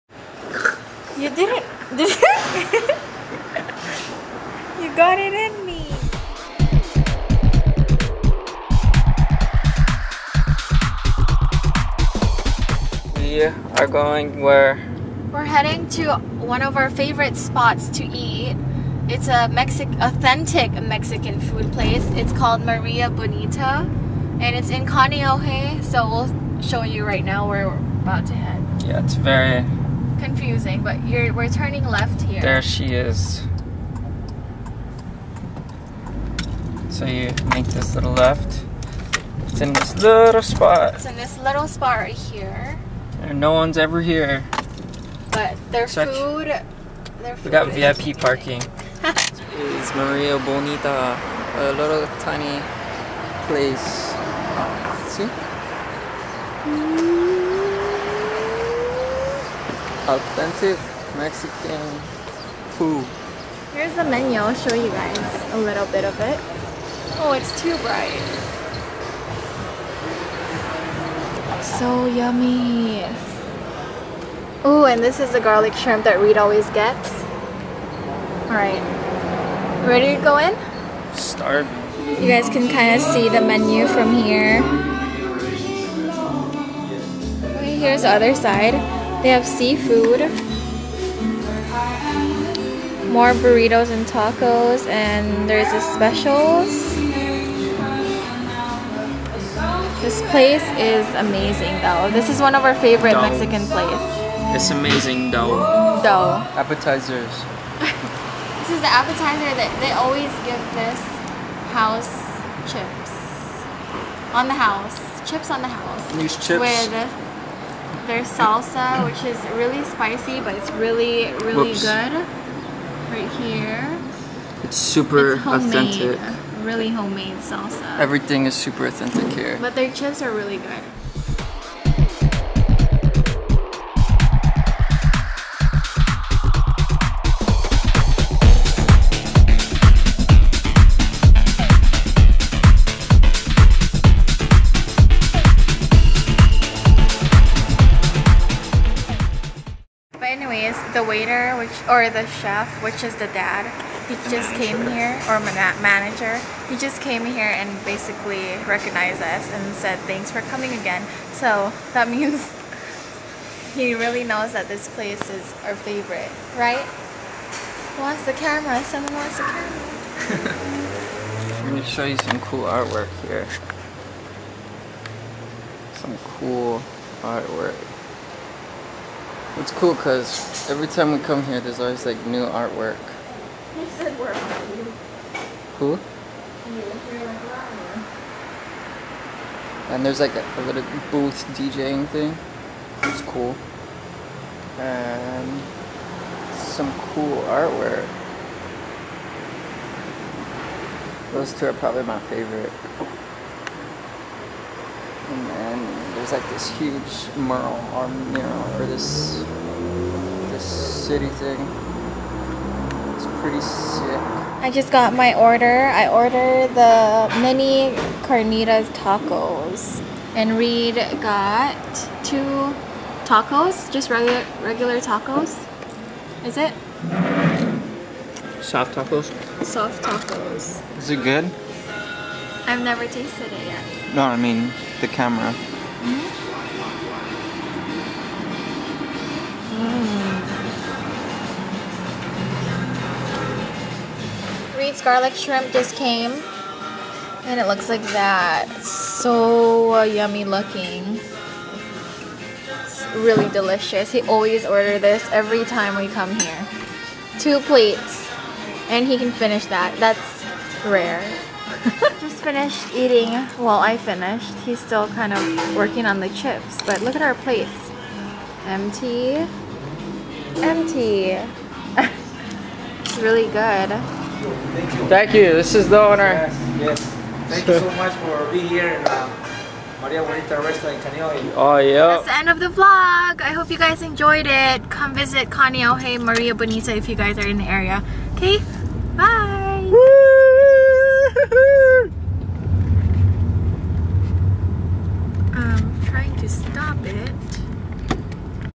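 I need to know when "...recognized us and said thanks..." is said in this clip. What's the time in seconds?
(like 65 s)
158 s.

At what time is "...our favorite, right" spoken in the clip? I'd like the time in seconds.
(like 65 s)
165 s.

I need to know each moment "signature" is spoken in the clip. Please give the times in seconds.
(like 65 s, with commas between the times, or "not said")
not said.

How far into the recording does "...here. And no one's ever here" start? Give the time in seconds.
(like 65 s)
42 s.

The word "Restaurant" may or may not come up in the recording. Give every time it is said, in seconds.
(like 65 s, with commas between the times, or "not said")
280 s.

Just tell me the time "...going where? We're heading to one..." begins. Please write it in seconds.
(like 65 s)
13 s.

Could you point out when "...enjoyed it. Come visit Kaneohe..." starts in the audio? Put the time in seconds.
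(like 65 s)
284 s.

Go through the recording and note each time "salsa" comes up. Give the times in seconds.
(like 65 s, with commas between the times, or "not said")
118 s, 127 s.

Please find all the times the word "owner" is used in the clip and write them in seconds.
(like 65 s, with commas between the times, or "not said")
276 s.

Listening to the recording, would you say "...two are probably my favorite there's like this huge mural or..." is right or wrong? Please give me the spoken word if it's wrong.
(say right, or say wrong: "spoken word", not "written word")
right.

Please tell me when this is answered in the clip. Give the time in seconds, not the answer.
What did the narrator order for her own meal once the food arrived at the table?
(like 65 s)
217 s.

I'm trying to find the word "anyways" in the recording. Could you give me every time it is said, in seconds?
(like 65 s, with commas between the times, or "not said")
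150 s.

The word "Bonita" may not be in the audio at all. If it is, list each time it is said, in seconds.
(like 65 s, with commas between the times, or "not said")
23 s, 50 s, 280 s, 286 s.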